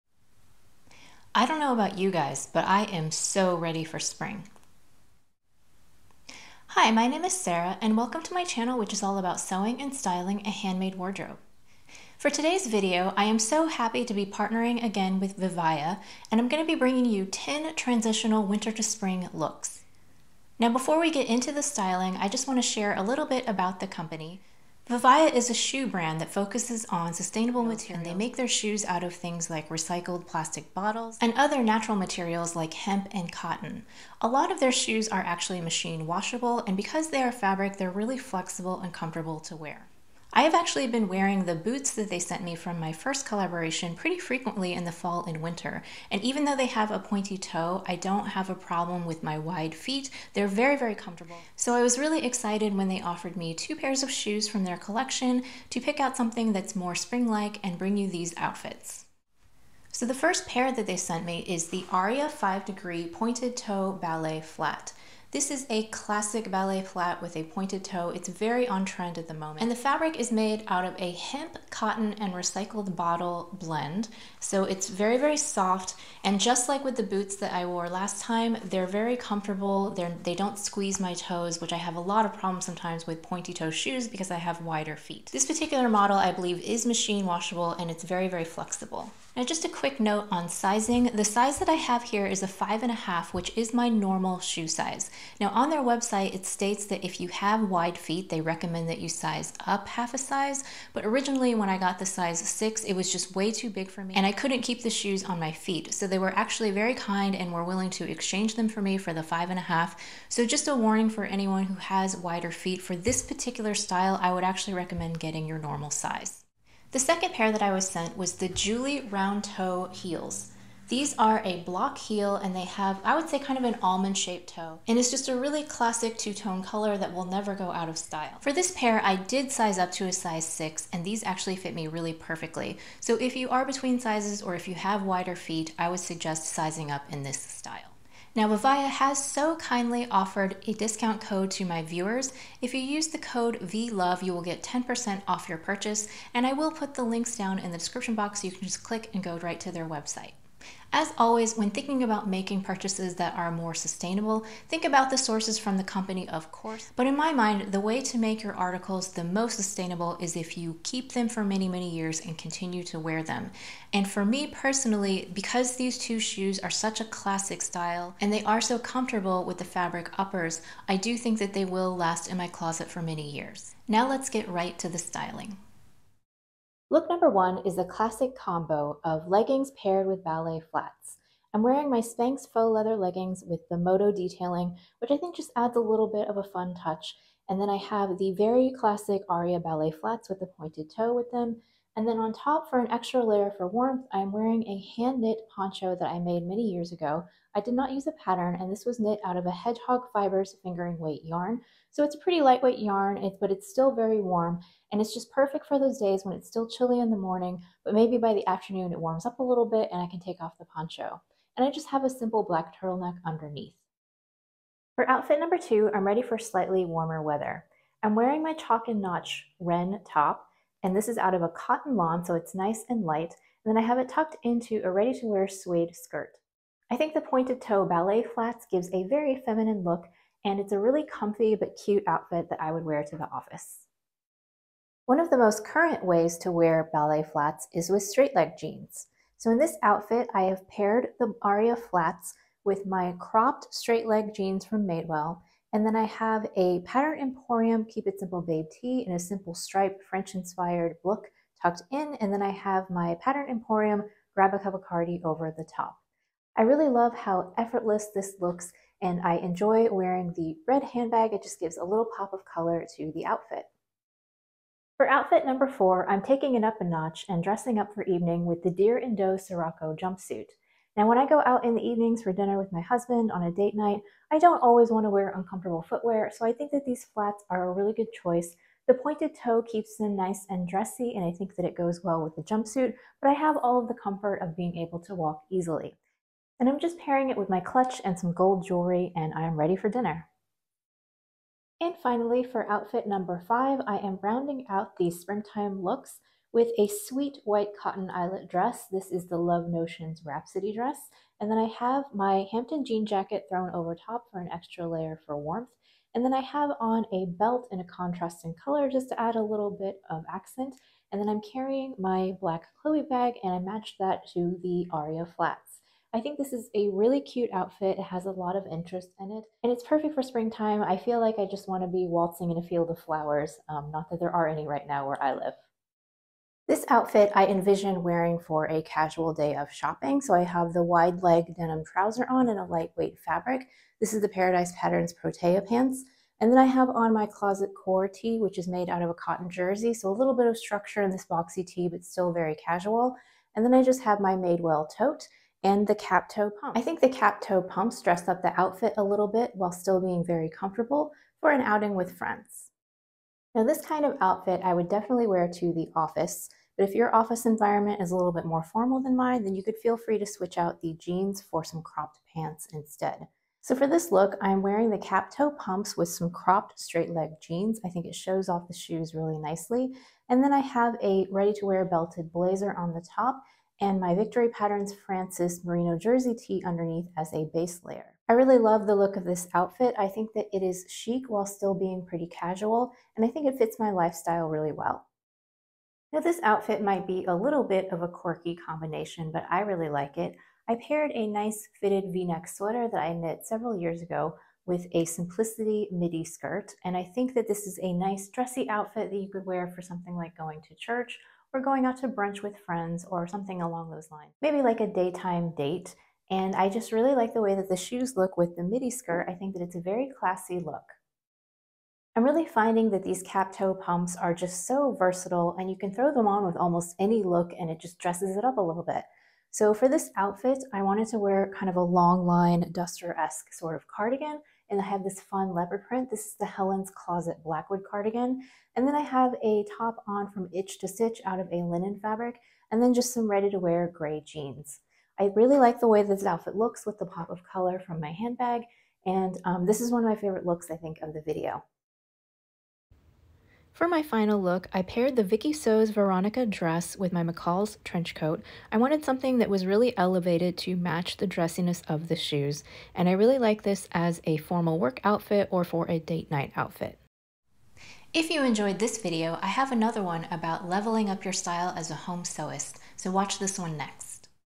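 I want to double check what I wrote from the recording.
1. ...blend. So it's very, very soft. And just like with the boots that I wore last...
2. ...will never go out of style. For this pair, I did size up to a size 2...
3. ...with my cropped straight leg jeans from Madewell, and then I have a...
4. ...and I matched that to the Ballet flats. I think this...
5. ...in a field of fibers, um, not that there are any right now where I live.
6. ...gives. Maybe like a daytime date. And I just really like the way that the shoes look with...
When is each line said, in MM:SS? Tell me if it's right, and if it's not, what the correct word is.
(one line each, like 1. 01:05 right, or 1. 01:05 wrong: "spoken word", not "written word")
1. 01:13 right
2. 02:07 wrong: "6", not "2"
3. 04:02 right
4. 05:13 wrong: "Aria", not "Ballet"
5. 05:22 wrong: "flowers", not "fibers"
6. 06:44 wrong: "lines", not "gives".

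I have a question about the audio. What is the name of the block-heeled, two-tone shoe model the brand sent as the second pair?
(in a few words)
Julie Round Toe Heels.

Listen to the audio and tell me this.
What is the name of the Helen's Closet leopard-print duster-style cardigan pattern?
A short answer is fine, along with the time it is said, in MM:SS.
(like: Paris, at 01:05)
Blackwood, at 07:07.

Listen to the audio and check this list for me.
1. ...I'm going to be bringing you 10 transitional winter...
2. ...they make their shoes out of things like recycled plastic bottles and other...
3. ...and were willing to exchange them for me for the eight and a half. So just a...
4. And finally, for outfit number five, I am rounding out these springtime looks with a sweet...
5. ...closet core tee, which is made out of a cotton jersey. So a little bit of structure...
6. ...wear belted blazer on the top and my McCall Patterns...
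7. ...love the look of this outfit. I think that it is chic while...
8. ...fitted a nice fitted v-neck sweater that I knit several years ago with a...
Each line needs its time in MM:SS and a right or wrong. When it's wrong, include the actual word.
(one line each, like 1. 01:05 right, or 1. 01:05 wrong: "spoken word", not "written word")
1. 00:16 right
2. 00:28 right
3. 01:47 wrong: "five", not "eight"
4. 04:51 right
5. 05:37 right
6. 06:11 wrong: "Victory", not "McCall"
7. 06:18 right
8. 06:30 wrong: "paired", not "fitted".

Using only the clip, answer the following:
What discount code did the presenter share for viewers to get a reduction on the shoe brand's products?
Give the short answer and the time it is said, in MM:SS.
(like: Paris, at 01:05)
VLOVE, at 02:23.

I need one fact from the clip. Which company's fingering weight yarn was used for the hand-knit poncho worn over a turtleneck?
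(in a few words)
Hedgehog Fibers.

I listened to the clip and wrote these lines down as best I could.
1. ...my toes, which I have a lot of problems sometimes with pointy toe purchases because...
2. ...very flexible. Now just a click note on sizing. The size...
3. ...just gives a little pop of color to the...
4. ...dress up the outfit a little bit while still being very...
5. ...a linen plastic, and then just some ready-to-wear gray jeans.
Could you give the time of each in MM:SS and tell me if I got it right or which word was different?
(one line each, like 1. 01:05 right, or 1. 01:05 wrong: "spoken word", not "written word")
1. 01:20 wrong: "shoes", not "purchases"
2. 01:28 wrong: "quick", not "click"
3. 04:21 right
4. 05:48 right
5. 07:11 wrong: "fabric", not "plastic".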